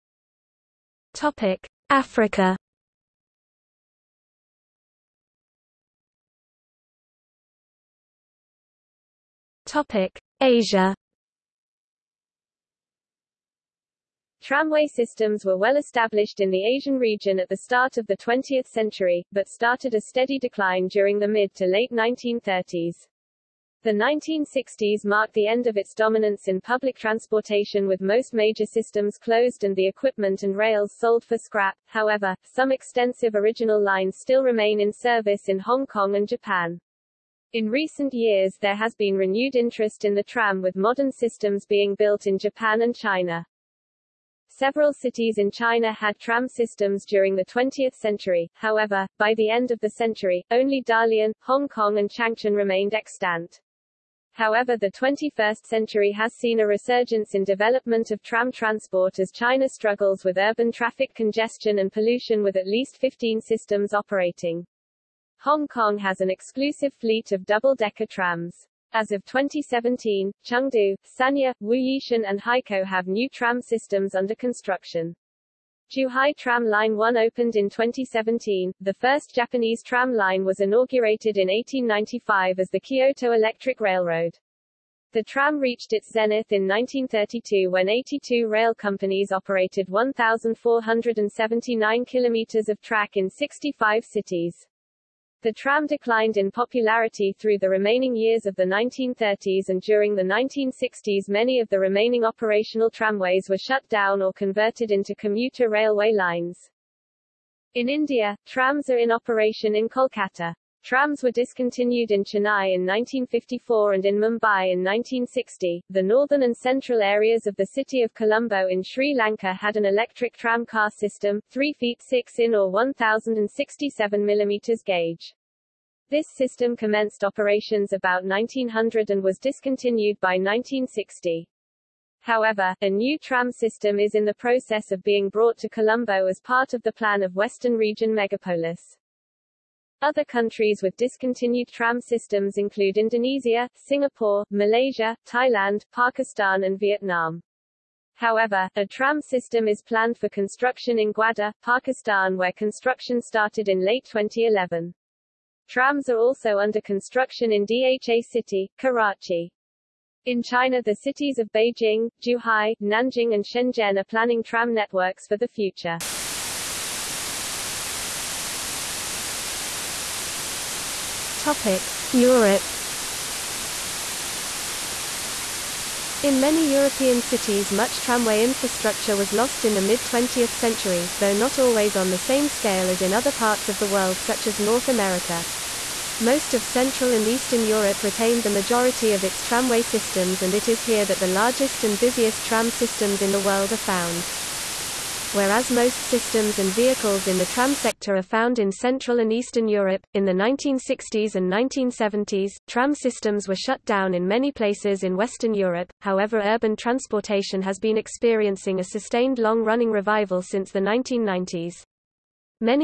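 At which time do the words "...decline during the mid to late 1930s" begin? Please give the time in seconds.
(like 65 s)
20 s.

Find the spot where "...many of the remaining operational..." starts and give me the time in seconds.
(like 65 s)
101 s.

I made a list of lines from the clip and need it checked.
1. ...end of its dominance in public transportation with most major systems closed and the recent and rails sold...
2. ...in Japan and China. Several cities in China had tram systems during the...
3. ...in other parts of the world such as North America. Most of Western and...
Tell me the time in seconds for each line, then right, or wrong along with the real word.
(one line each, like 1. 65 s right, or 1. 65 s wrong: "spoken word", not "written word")
1. 25 s wrong: "equipment", not "recent"
2. 42 s right
3. 183 s wrong: "Central", not "Western".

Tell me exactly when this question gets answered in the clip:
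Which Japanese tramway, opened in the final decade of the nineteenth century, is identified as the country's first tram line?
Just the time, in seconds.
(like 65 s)
82 s.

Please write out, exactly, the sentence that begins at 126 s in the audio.
This system commenced operations about 1900 and was discontinued by 1960.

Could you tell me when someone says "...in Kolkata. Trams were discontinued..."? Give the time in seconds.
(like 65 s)
109 s.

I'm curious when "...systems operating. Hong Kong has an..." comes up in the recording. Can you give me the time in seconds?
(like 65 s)
63 s.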